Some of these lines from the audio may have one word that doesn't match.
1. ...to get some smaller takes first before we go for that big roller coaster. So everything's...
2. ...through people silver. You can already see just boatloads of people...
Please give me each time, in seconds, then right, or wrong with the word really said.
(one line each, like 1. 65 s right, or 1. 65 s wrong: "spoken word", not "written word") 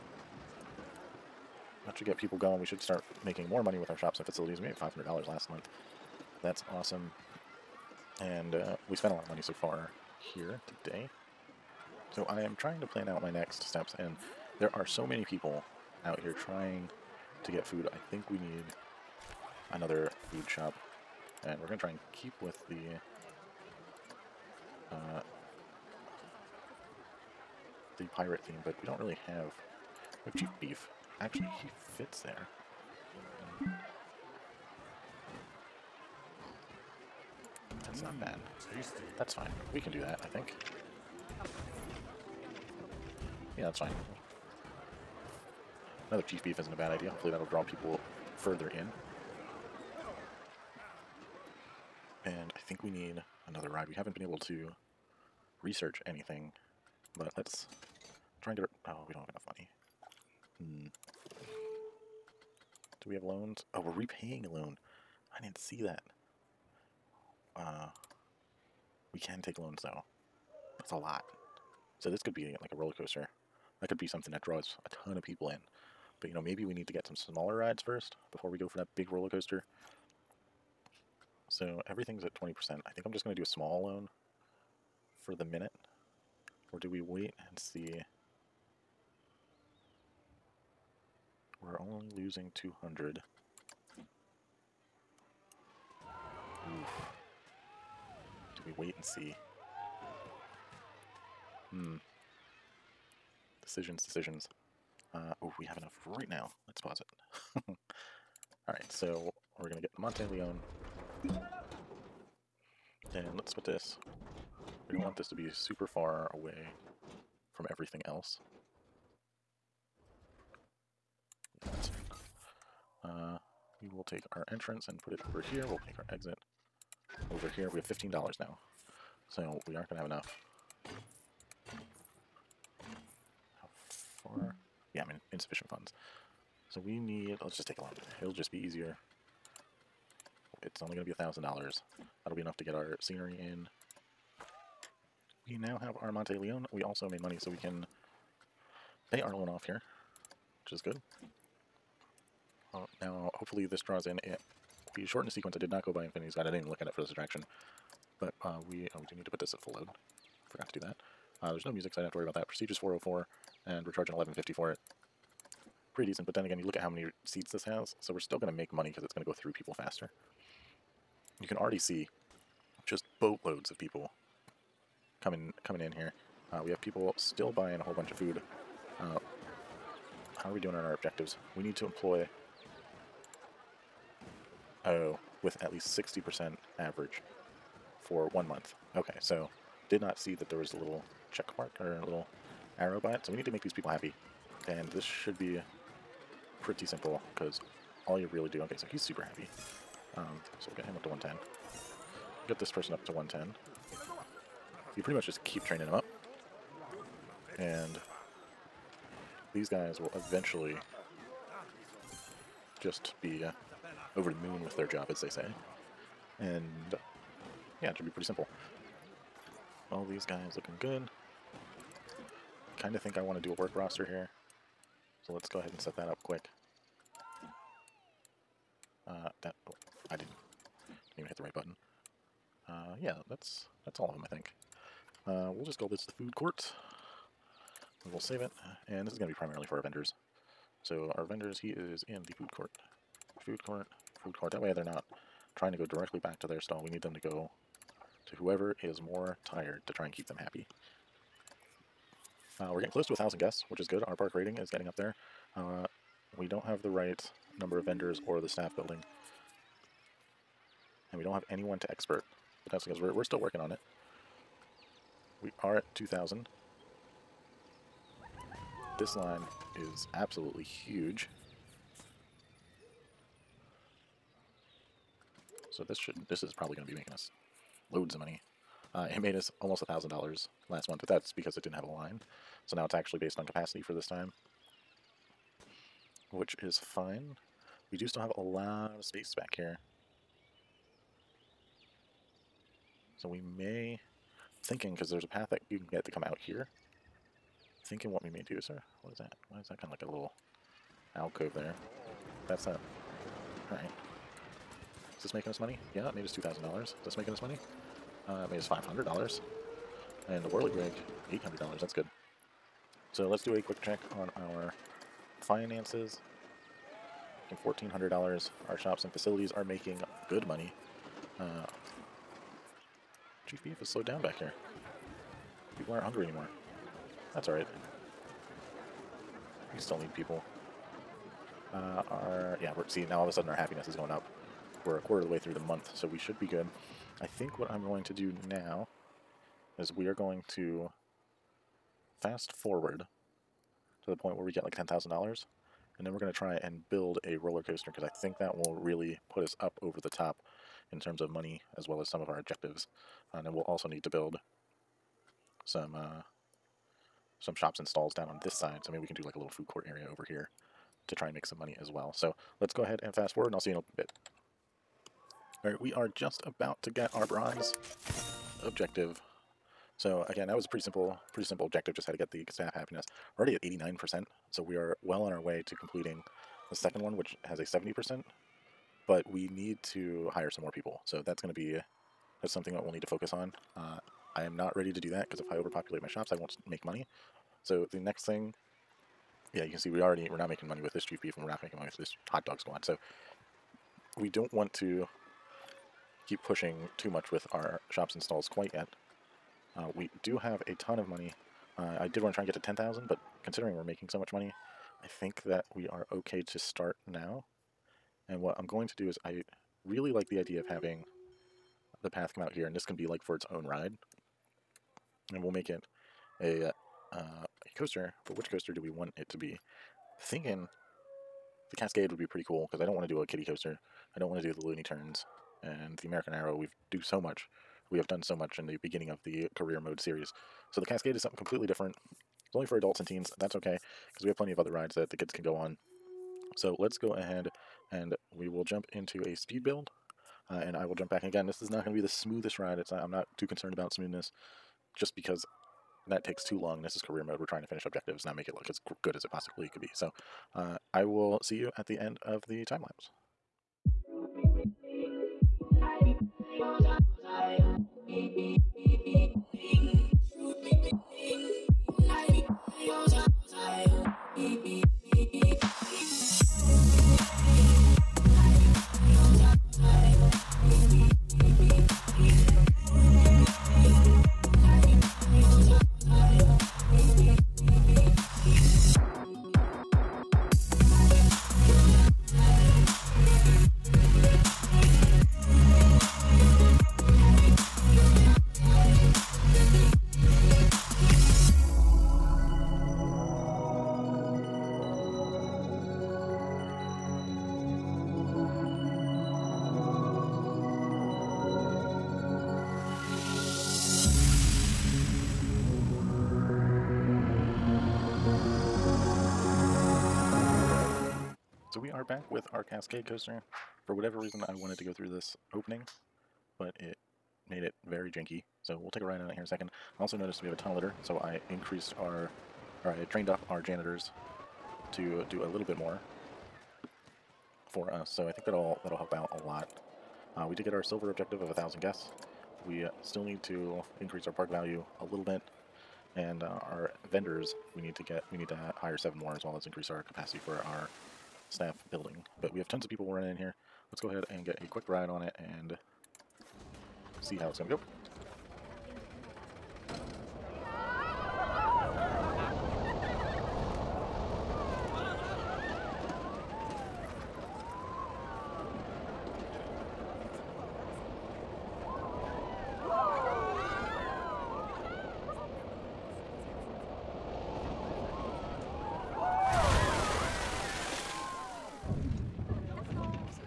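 1. 76 s wrong: "rides", not "takes"
2. 169 s wrong: "faster", not "silver".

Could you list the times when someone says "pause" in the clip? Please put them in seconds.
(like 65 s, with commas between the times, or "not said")
106 s.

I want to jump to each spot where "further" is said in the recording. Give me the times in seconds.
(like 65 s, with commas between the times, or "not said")
48 s.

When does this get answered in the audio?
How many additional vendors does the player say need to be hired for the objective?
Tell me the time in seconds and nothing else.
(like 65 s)
538 s.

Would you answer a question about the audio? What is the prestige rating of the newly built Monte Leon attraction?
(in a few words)
404.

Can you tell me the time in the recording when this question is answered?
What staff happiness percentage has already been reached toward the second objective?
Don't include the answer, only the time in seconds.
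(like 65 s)
373 s.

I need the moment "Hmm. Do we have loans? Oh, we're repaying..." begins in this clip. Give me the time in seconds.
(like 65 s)
60 s.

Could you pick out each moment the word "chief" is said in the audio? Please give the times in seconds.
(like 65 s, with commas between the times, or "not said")
30 s, 46 s, 323 s, 391 s.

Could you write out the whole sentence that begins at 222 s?
Kind of think I want to do a work roster here.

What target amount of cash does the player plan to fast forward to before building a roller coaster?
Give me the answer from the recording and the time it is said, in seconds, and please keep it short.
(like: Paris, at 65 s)
10,000 dollars, at 344 s.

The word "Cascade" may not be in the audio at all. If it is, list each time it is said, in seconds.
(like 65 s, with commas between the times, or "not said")
421 s, 430 s, 512 s.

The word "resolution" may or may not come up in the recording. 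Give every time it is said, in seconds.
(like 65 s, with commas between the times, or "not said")
not said.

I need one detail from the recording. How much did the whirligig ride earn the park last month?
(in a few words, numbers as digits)
$800.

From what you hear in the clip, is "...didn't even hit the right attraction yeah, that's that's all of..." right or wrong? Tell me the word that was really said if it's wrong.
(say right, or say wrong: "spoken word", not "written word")
wrong: "button", not "attraction".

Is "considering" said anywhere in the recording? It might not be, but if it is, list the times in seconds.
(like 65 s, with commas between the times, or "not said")
403 s.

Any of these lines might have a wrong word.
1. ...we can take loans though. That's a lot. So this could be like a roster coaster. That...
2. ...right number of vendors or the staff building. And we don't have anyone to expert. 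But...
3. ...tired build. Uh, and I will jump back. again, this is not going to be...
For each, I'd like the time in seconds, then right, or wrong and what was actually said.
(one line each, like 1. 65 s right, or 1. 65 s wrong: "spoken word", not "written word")
1. 69 s wrong: "roller", not "roster"
2. 256 s right
3. 439 s wrong: "speed", not "tired".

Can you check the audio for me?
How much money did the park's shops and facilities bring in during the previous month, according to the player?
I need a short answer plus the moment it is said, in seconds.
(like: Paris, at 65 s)
$500, at 4 s.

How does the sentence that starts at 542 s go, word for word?
But we have tons of people running in here.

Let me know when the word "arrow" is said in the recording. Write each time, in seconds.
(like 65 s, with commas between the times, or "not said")
192 s, 426 s.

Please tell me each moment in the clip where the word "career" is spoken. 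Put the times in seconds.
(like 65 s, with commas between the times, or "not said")
429 s, 447 s.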